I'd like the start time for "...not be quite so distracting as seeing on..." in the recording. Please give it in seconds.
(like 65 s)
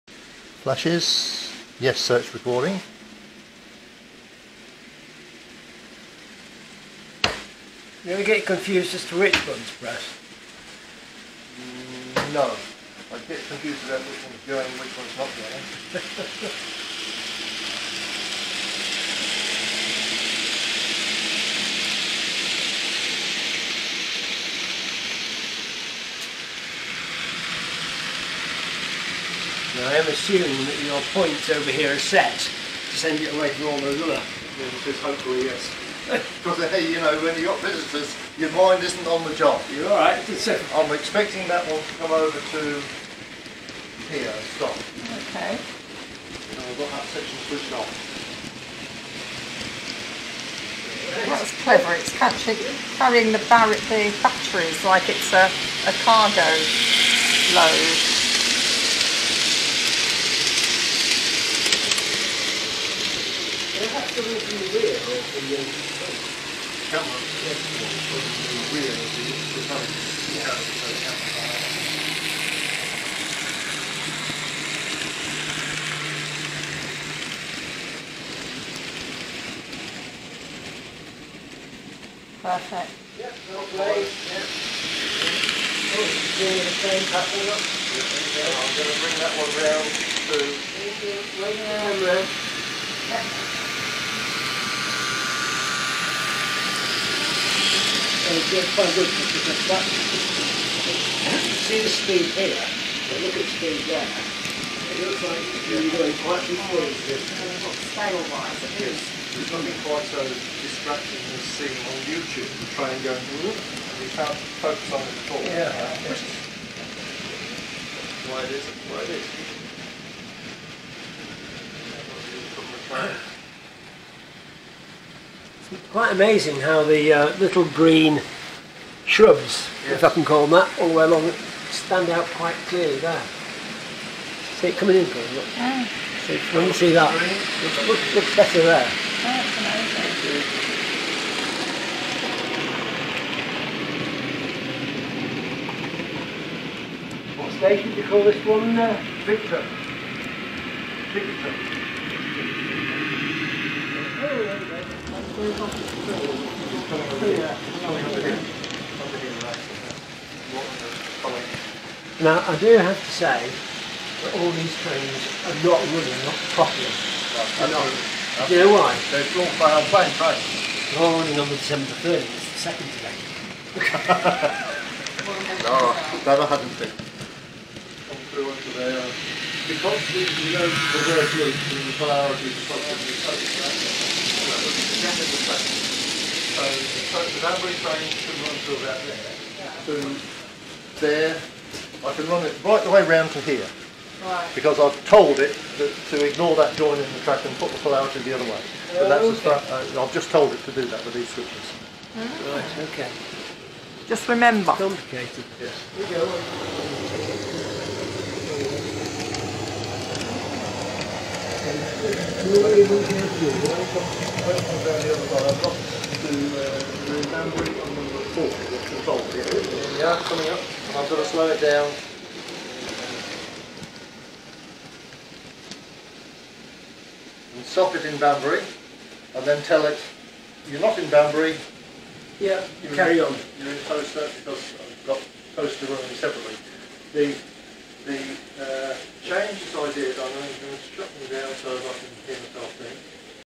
109 s.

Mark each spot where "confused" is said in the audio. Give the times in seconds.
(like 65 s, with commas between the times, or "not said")
8 s, 13 s.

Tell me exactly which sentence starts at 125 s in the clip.
Quite amazing how the uh, little green shrubs, yes.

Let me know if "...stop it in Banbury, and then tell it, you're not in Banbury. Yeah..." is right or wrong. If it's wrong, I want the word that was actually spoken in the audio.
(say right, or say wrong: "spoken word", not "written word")
right.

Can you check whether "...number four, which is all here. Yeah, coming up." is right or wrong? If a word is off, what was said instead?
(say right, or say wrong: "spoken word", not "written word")
right.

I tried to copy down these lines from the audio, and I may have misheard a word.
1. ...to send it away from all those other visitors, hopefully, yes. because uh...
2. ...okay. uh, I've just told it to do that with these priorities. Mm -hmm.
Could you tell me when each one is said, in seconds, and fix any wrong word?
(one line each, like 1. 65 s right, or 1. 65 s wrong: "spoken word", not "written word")
1. 32 s right
2. 199 s wrong: "switches", not "priorities".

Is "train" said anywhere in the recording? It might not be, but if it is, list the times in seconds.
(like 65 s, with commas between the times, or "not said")
112 s, 164 s, 187 s.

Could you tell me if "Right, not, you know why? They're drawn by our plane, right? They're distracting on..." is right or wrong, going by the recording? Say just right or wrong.
wrong.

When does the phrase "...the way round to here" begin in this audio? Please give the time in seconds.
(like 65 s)
192 s.